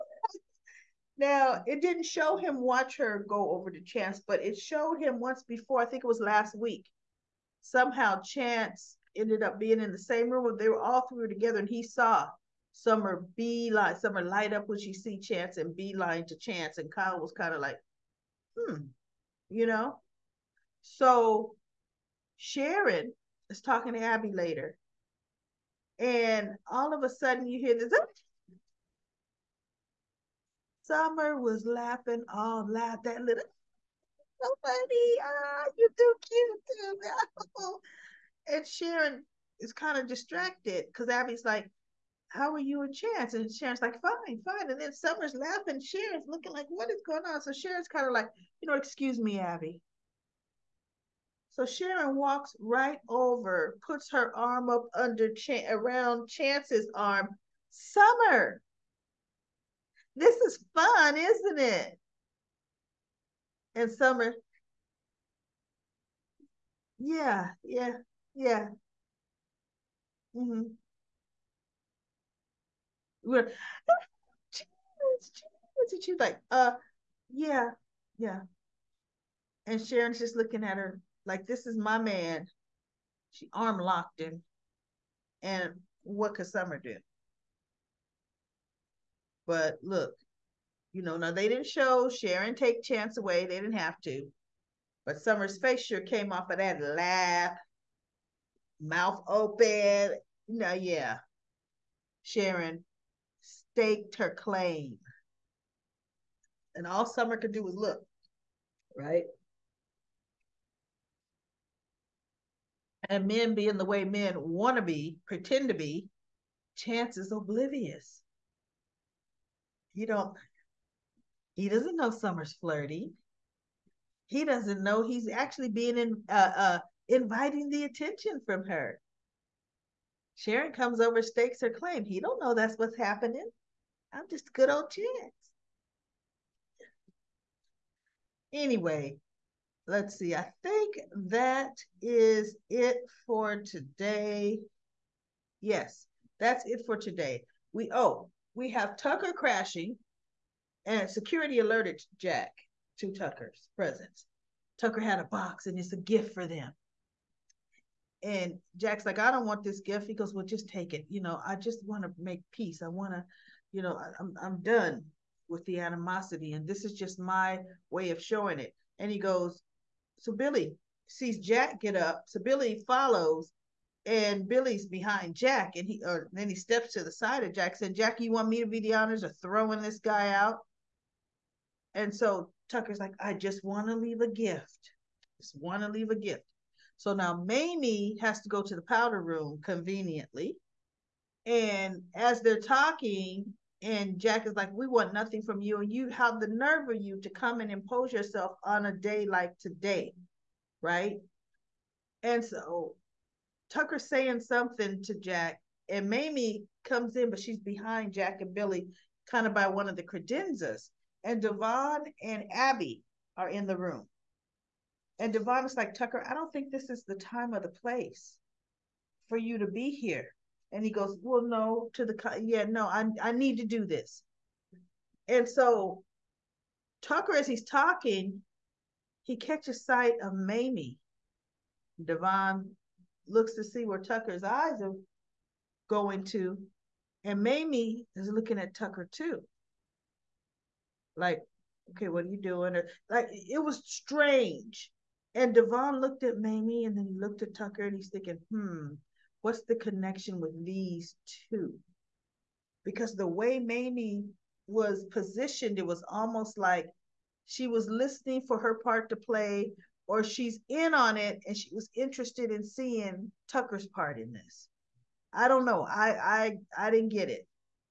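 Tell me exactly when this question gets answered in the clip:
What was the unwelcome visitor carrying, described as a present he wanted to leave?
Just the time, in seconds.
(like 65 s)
155 s.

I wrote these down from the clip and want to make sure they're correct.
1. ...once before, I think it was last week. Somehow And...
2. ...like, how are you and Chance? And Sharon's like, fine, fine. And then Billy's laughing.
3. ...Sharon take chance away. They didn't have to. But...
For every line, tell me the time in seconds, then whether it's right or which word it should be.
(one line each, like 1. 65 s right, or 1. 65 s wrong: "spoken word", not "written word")
1. 5 s wrong: "Chance", not "And"
2. 41 s wrong: "Summer", not "Billy"
3. 92 s right.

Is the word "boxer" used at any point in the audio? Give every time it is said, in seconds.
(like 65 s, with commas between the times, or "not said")
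not said.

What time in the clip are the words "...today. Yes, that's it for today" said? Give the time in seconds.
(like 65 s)
143 s.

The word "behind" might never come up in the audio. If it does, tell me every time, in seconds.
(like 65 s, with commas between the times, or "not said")
174 s, 207 s.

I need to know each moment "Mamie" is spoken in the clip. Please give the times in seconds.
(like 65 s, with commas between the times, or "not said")
187 s, 206 s, 230 s, 237 s, 246 s, 253 s.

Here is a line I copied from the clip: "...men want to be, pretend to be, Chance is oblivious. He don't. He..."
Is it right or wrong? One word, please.
right.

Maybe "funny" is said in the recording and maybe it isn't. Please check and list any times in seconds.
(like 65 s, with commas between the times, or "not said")
34 s.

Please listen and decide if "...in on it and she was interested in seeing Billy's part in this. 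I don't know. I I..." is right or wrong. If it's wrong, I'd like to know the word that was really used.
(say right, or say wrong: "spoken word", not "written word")
wrong: "Tucker", not "Billy".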